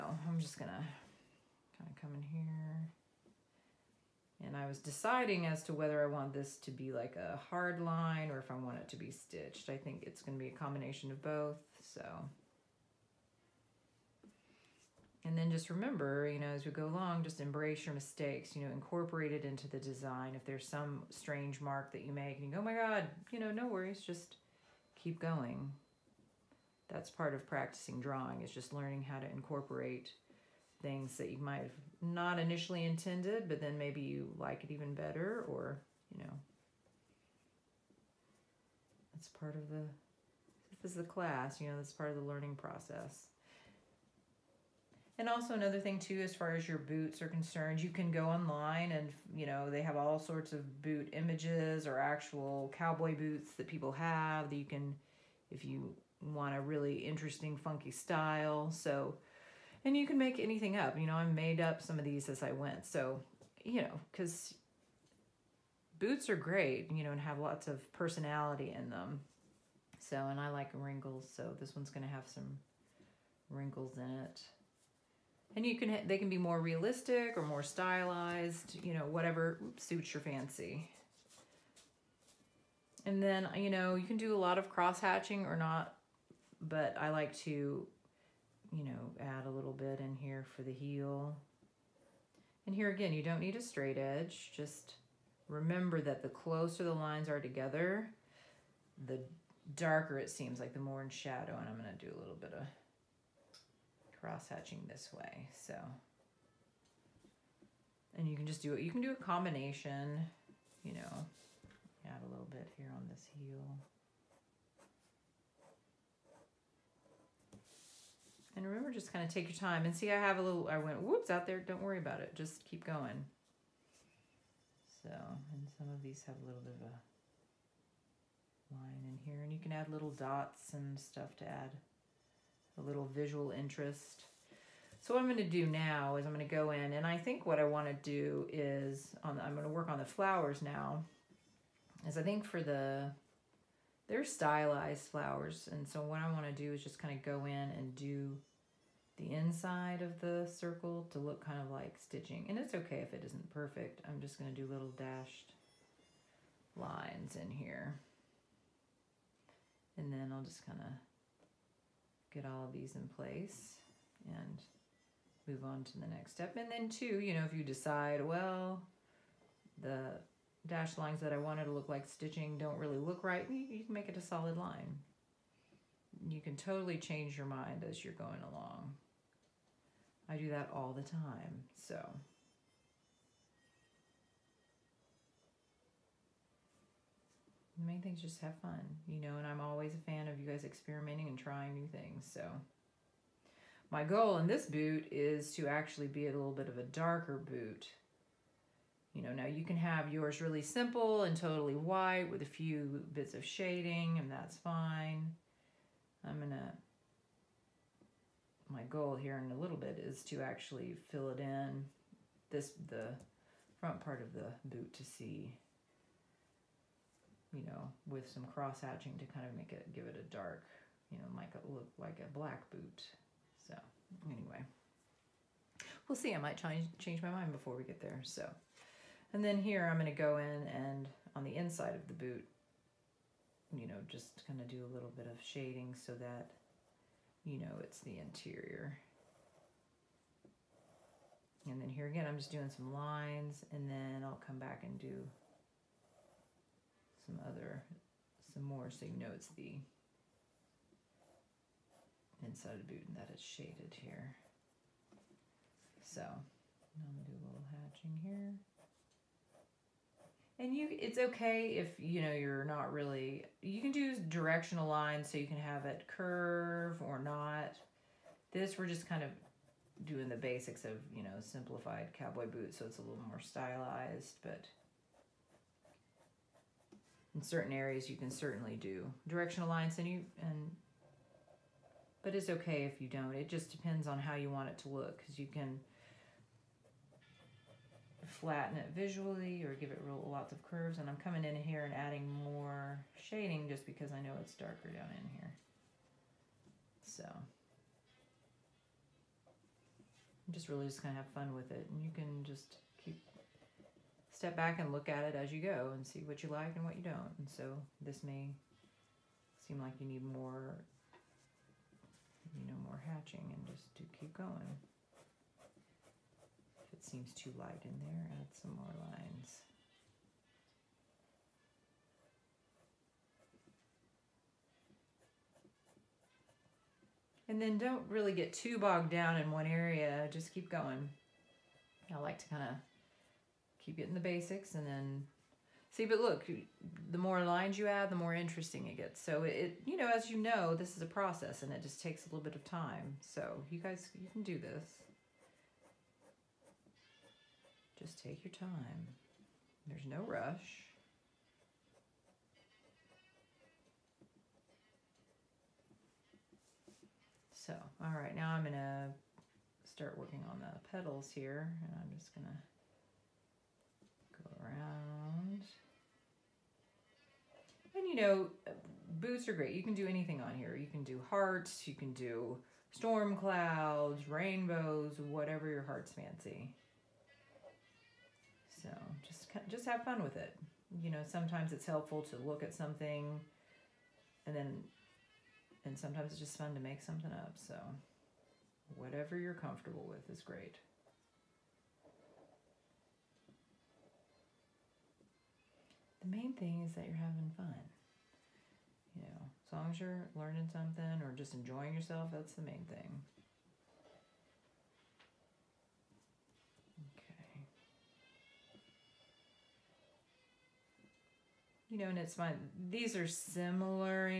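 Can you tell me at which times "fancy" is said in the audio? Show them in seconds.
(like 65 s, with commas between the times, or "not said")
80 s, 376 s.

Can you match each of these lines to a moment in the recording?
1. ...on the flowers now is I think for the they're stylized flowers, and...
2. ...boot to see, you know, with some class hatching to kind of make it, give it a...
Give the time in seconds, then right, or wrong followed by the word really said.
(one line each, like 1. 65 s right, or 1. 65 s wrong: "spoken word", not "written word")
1. 139 s right
2. 214 s wrong: "cross", not "class".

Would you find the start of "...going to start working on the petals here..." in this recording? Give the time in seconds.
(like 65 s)
358 s.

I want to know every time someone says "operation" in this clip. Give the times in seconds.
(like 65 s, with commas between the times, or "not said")
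not said.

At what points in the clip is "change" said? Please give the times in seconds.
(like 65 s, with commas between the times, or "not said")
176 s, 226 s.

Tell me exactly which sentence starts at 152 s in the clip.
And it's okay if it isn't perfect.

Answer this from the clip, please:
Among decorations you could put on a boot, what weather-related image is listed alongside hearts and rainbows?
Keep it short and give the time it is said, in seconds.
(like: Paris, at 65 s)
Storm clouds, at 372 s.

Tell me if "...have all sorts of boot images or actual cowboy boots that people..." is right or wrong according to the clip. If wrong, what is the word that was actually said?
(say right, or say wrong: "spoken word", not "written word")
right.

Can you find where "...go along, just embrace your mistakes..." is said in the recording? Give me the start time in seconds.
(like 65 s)
16 s.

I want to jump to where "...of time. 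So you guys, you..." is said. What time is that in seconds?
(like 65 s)
342 s.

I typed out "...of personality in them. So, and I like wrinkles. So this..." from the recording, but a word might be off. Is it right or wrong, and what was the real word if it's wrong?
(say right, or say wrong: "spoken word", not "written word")
right.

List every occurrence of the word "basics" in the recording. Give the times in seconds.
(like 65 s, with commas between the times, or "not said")
270 s, 334 s.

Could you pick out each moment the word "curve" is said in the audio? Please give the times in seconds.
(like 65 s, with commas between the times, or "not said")
266 s, 290 s.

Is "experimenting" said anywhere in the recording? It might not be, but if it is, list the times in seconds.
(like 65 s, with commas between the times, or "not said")
190 s.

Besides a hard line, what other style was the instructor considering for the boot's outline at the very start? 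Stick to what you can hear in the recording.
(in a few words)
Stitched.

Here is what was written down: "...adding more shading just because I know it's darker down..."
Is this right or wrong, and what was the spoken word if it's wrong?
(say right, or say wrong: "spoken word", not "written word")
right.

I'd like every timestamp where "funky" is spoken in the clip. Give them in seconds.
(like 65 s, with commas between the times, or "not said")
57 s.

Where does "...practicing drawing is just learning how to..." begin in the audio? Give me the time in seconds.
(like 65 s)
27 s.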